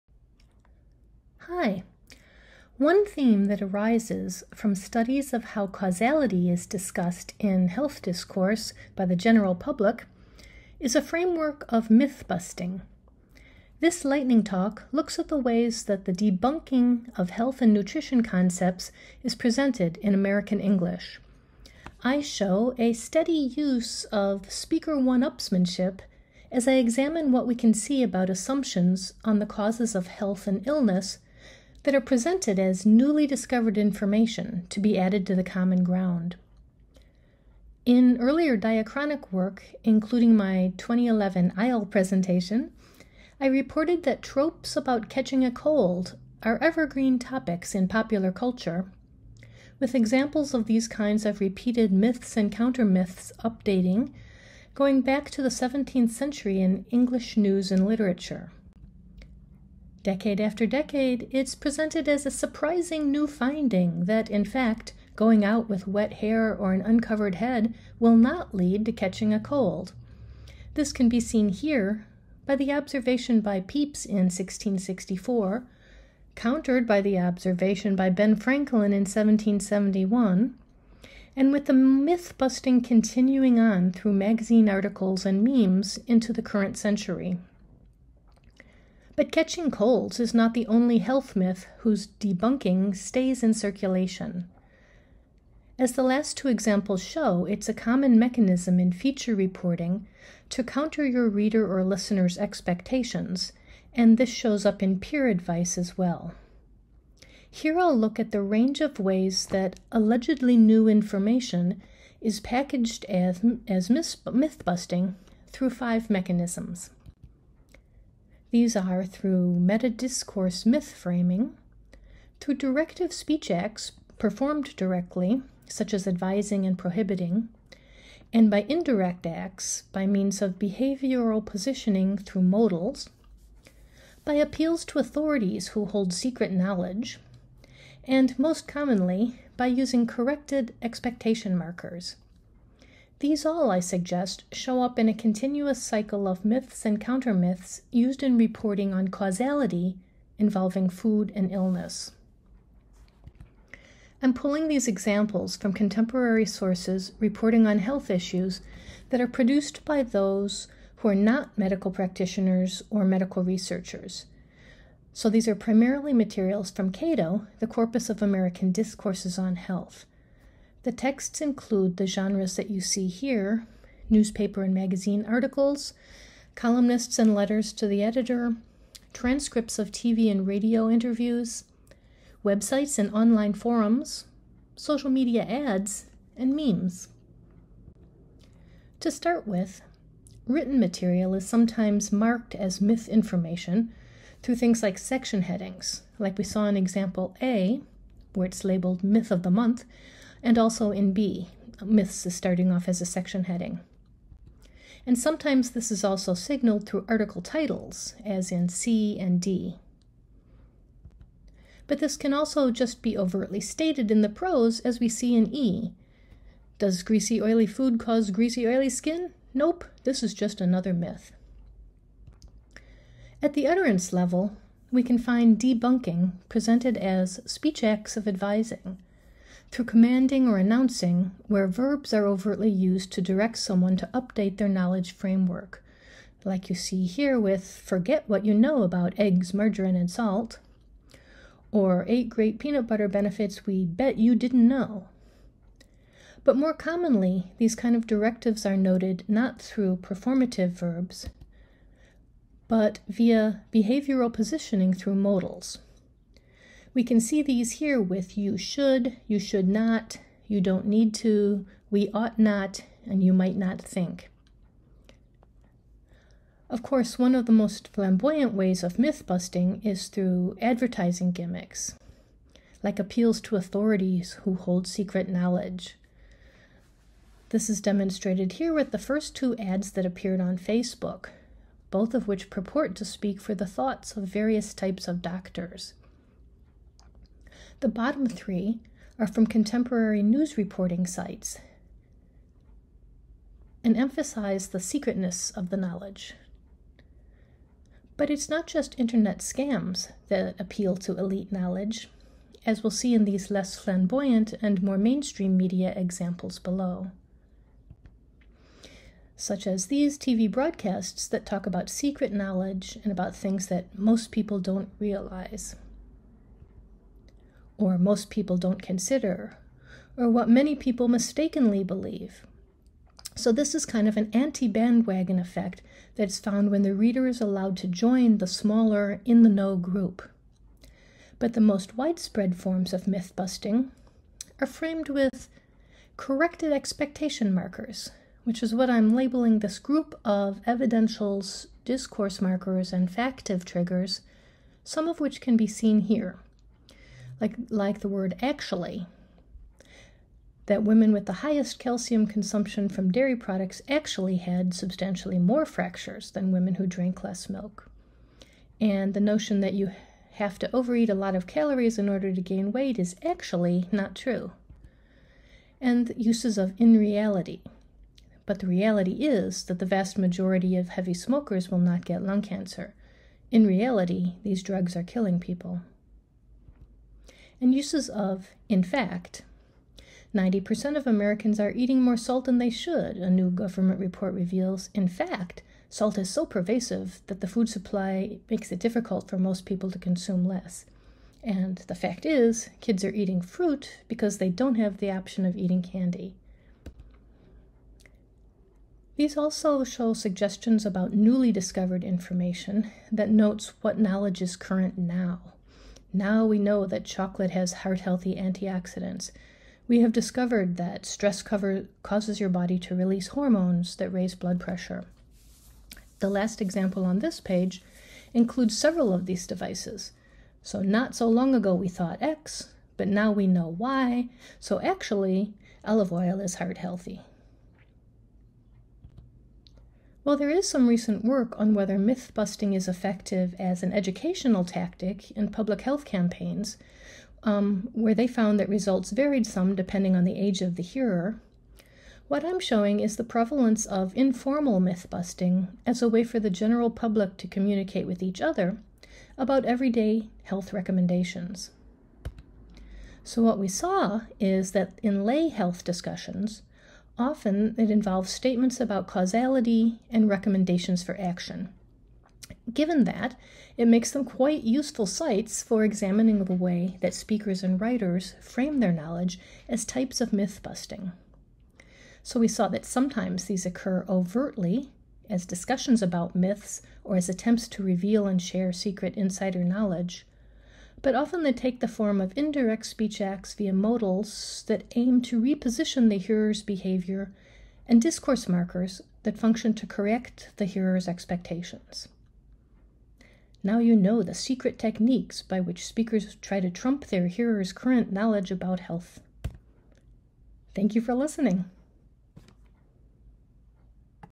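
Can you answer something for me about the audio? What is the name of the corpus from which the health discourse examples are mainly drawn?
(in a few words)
CADOH.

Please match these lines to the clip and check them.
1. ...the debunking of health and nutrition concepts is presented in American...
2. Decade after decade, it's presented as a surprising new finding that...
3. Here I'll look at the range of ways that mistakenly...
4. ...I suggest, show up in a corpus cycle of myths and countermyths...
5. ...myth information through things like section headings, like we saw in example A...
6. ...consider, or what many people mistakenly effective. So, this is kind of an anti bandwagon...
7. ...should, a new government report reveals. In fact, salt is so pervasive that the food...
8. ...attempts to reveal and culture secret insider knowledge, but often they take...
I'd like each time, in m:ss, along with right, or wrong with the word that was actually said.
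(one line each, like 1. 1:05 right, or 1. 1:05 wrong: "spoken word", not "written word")
1. 0:16 right
2. 1:00 right
3. 1:47 wrong: "allegedly", not "mistakenly"
4. 2:23 wrong: "continuous", not "corpus"
5. 3:12 right
6. 5:18 wrong: "believe", not "effective"
7. 6:22 right
8. 7:57 wrong: "share", not "culture".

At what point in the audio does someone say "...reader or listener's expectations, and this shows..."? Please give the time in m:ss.
1:41.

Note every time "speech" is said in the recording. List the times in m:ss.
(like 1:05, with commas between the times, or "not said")
2:03, 3:47, 8:02.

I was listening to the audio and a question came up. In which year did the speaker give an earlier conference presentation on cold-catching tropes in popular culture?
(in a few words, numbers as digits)
2011.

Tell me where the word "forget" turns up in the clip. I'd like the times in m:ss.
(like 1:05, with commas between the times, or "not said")
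3:57.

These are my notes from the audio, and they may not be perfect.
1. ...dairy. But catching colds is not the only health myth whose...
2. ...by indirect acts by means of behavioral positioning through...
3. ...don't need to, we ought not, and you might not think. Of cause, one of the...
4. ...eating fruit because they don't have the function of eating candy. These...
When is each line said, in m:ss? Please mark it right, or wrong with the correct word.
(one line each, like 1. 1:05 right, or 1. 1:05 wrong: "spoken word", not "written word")
1. 1:26 wrong: "century", not "dairy"
2. 2:08 right
3. 4:20 wrong: "course", not "cause"
4. 6:33 wrong: "option", not "function".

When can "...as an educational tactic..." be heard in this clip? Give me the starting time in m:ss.
7:13.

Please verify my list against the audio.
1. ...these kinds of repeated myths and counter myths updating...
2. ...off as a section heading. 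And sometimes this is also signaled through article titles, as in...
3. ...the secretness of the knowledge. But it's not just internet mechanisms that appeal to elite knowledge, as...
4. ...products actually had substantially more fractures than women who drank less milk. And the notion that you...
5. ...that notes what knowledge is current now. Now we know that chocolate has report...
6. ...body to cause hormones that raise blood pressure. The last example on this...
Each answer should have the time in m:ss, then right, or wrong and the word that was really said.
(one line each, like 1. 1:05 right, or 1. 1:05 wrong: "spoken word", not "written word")
1. 0:50 right
2. 3:22 right
3. 4:54 wrong: "scams", not "mechanisms"
4. 5:53 right
5. 6:43 wrong: "heart", not "report"
6. 6:52 wrong: "release", not "cause".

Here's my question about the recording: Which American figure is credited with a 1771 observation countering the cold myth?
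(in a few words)
Ben Franklin.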